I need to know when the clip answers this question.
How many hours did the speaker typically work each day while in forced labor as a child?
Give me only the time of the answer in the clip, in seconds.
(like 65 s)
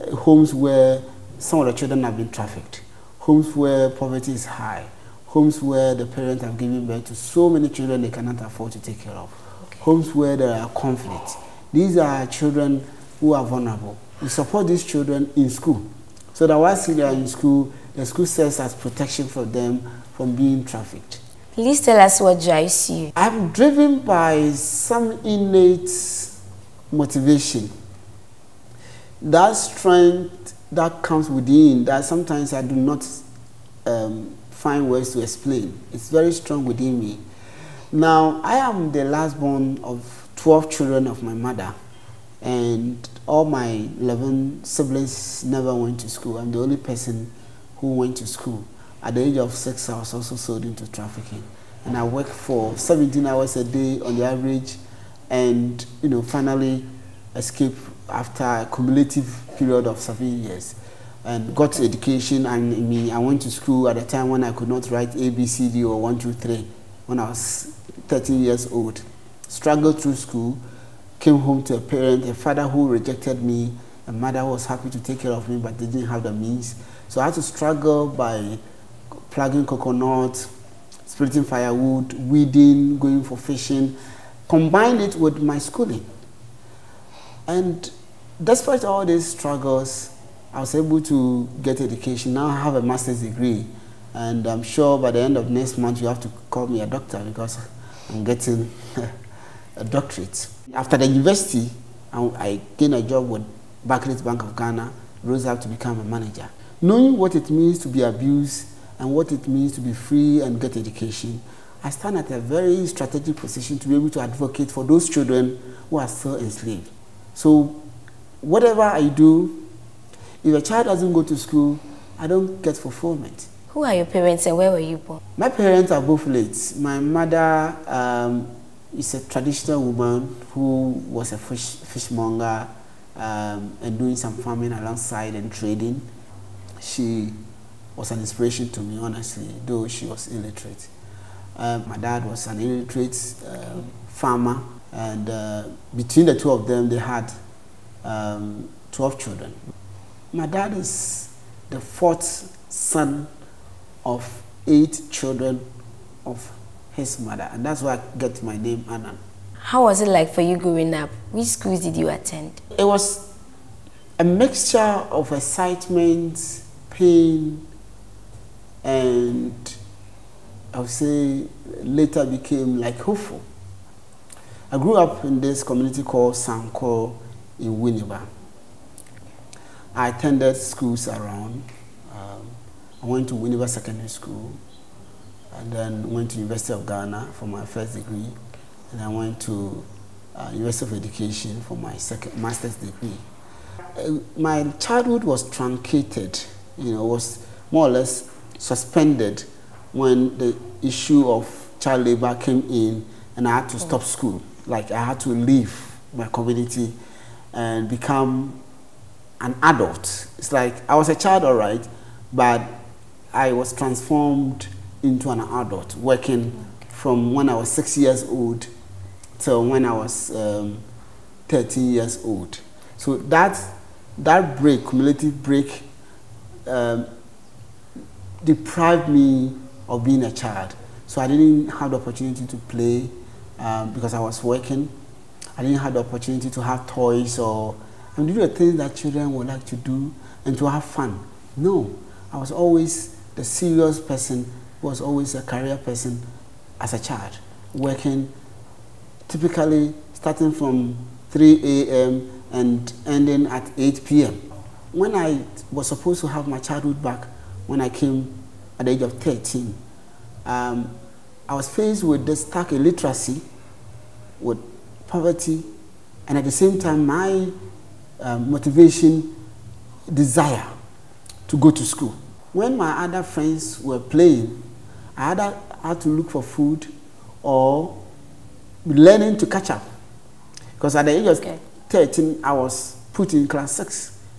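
52 s.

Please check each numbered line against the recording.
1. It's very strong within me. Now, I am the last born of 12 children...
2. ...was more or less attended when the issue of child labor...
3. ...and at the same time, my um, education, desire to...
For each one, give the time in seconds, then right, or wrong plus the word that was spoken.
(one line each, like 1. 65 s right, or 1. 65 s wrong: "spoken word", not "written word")
1. 35 s right
2. 197 s wrong: "suspended", not "attended"
3. 266 s wrong: "motivation", not "education".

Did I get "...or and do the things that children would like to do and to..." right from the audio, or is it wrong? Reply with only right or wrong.
right.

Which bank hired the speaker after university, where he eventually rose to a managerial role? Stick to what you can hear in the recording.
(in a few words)
Barclays Bank of Ghana.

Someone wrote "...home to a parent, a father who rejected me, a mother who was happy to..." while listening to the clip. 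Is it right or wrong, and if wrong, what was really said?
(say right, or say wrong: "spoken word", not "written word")
right.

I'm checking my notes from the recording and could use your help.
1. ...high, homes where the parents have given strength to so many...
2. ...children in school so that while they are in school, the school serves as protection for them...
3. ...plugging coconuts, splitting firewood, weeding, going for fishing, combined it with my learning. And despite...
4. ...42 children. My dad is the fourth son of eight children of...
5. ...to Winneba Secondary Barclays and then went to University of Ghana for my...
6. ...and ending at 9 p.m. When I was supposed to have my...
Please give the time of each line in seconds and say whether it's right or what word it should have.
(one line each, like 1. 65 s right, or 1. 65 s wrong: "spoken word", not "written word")
1. 4 s wrong: "birth", not "strength"
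2. 14 s right
3. 79 s wrong: "schooling", not "learning"
4. 148 s wrong: "12", not "42"
5. 183 s wrong: "School", not "Barclays"
6. 252 s wrong: "8", not "9".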